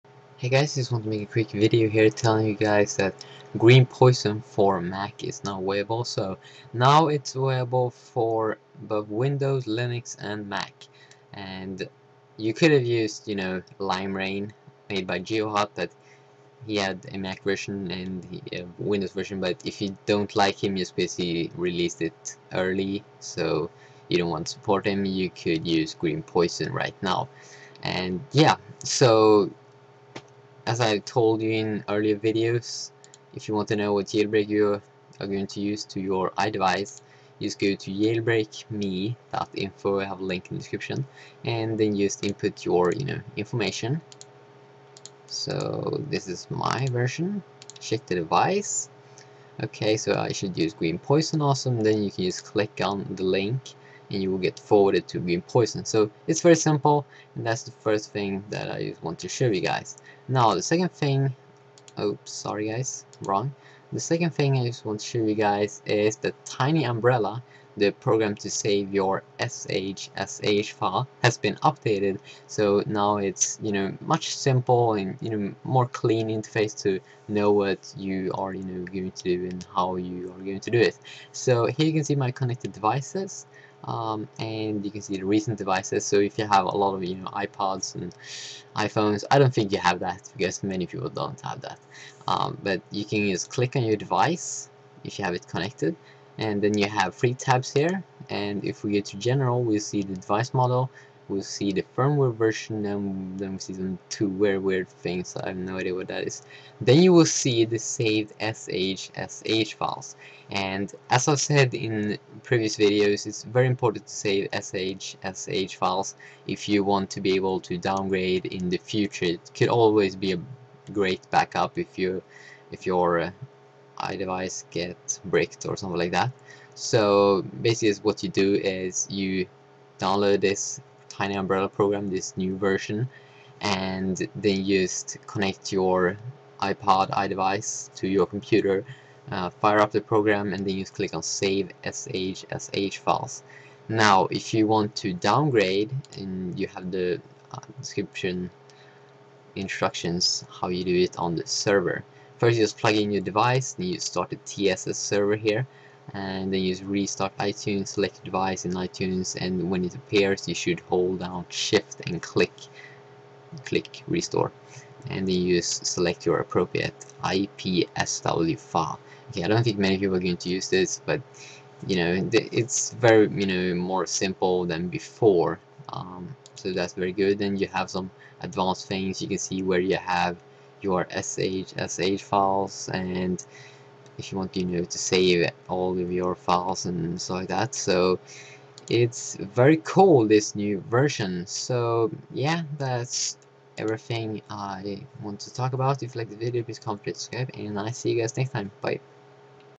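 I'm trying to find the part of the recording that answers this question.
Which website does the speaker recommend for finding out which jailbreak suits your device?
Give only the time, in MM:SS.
00:37.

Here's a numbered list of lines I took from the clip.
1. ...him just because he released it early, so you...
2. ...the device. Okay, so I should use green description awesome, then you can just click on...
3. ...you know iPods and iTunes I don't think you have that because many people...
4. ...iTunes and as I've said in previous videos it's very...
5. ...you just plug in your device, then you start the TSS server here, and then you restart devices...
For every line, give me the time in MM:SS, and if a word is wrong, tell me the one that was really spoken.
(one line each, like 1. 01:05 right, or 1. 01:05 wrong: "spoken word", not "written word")
1. 00:20 right
2. 00:48 wrong: "poison", not "description"
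3. 01:27 wrong: "iPhones", not "iTunes"
4. 01:49 wrong: "files", not "iTunes"
5. 02:32 wrong: "iTunes", not "devices".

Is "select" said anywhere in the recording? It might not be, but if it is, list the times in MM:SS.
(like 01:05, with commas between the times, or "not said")
02:37, 02:45.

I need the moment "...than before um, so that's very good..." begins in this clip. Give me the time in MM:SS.
02:54.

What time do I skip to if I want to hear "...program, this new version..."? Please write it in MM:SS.
02:11.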